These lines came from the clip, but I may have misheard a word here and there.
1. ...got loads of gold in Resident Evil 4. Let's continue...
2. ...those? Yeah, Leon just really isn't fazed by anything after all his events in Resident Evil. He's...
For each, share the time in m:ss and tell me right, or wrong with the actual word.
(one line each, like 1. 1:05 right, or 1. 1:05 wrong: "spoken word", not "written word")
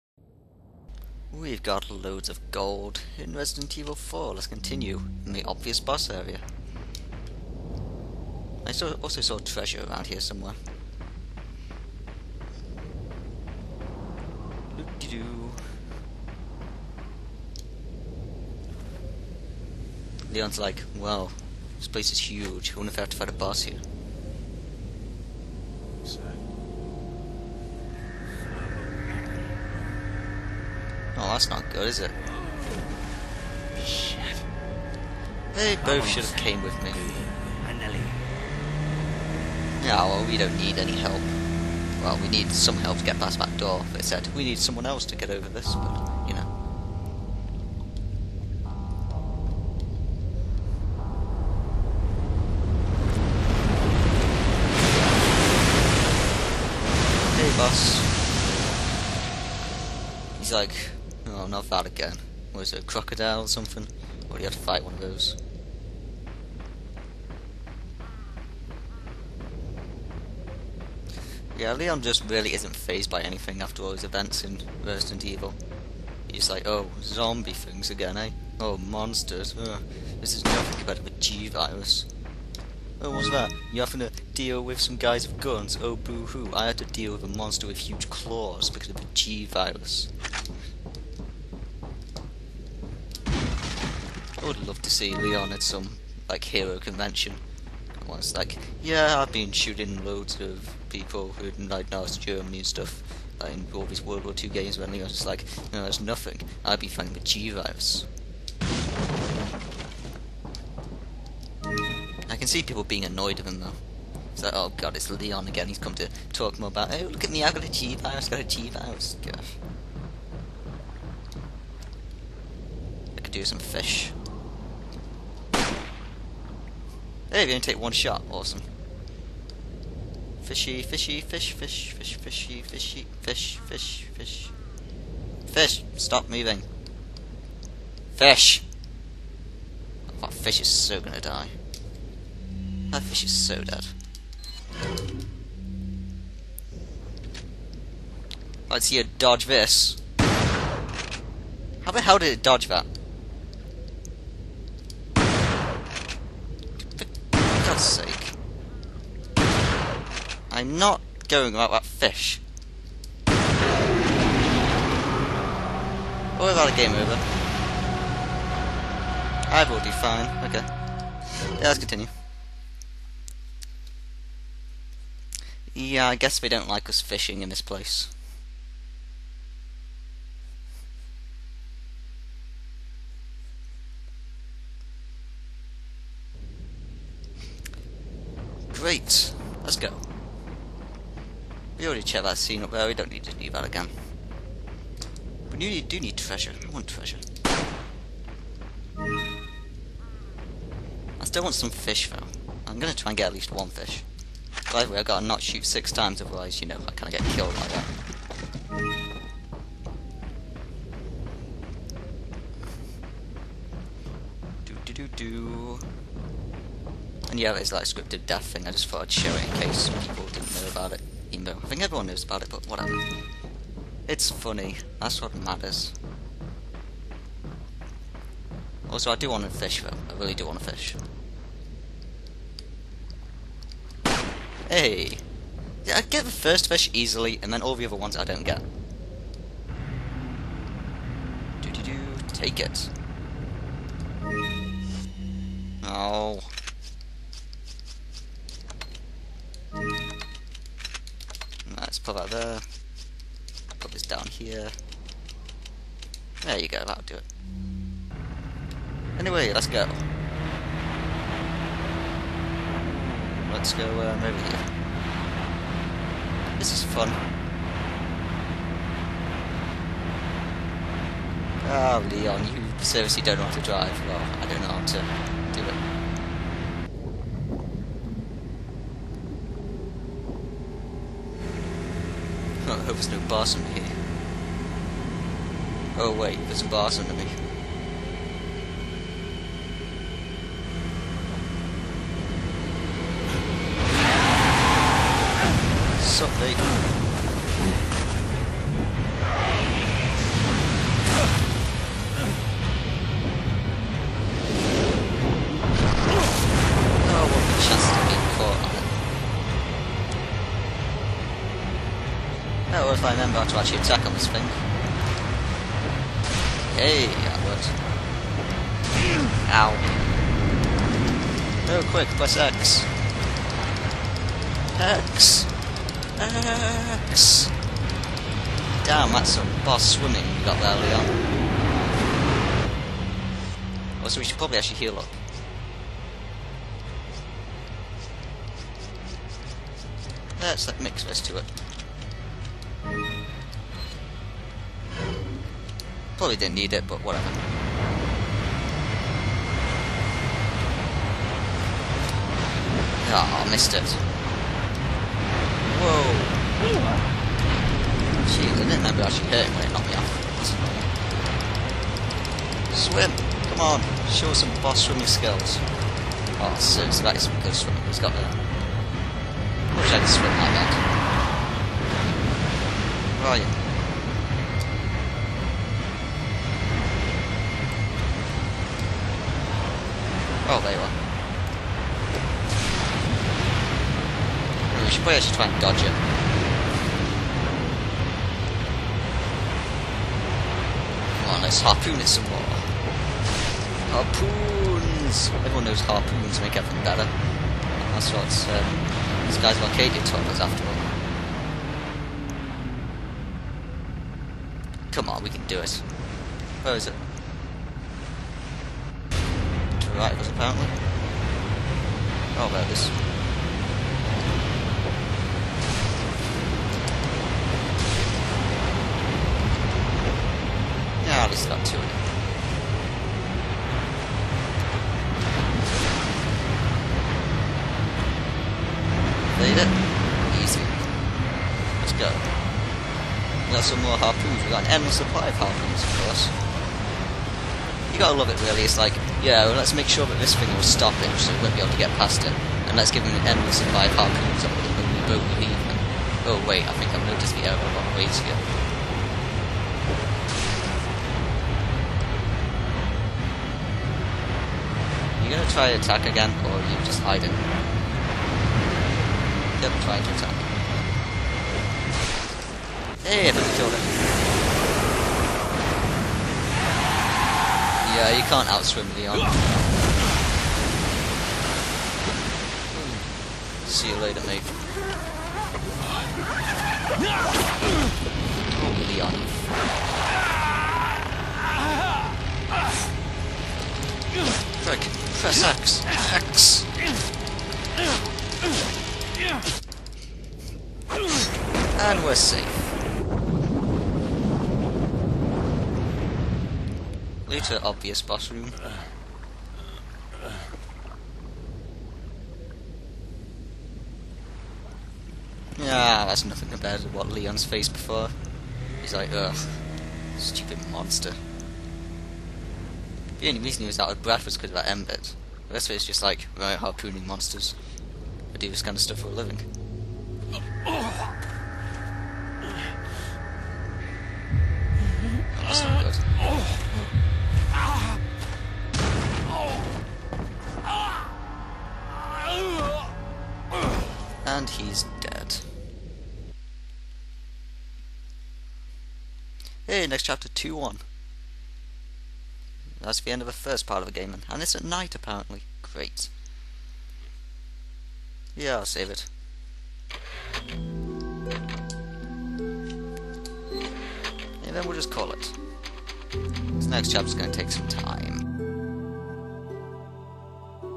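1. 0:01 right
2. 1:05 right.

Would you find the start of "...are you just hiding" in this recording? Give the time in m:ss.
7:36.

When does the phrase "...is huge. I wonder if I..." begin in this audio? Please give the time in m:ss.
0:22.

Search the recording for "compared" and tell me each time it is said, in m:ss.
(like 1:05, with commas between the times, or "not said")
1:20, 8:26.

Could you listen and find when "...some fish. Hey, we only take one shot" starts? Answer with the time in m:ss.
2:03.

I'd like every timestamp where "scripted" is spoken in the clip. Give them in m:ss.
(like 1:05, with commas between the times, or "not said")
3:37.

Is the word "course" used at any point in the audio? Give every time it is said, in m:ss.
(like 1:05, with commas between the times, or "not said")
7:16.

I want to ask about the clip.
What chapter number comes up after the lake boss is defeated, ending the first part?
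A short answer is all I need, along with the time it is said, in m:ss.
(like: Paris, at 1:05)
2-1, at 9:00.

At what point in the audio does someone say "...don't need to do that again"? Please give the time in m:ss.
3:12.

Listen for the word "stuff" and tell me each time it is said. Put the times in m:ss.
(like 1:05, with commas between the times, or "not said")
1:42, 8:38.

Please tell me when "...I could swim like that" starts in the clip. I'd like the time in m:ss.
6:09.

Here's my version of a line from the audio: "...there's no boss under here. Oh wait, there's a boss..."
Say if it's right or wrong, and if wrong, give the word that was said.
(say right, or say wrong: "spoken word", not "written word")
right.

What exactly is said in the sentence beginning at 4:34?
Well, I don't know how to do it.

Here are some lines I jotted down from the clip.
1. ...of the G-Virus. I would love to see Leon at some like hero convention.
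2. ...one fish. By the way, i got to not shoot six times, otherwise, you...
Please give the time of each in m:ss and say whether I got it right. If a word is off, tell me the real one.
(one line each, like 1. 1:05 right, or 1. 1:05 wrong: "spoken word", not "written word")
1. 1:28 right
2. 3:23 right.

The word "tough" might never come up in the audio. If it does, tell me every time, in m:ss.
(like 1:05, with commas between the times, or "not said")
not said.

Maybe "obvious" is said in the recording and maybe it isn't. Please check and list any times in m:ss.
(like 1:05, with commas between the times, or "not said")
0:05, 8:17.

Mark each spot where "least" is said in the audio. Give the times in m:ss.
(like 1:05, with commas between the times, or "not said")
3:23.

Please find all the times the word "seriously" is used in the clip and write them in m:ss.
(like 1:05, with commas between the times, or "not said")
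4:32, 6:06.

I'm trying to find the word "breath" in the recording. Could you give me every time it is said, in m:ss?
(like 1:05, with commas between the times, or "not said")
8:34.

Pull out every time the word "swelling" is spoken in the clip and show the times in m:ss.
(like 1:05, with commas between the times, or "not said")
not said.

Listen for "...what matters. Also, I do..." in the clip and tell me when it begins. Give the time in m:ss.
3:45.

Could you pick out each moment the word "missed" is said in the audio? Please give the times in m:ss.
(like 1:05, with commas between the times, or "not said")
5:53.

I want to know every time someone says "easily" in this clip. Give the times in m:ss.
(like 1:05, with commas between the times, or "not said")
3:56.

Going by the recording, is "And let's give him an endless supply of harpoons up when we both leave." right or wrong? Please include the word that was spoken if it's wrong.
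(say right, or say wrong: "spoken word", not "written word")
right.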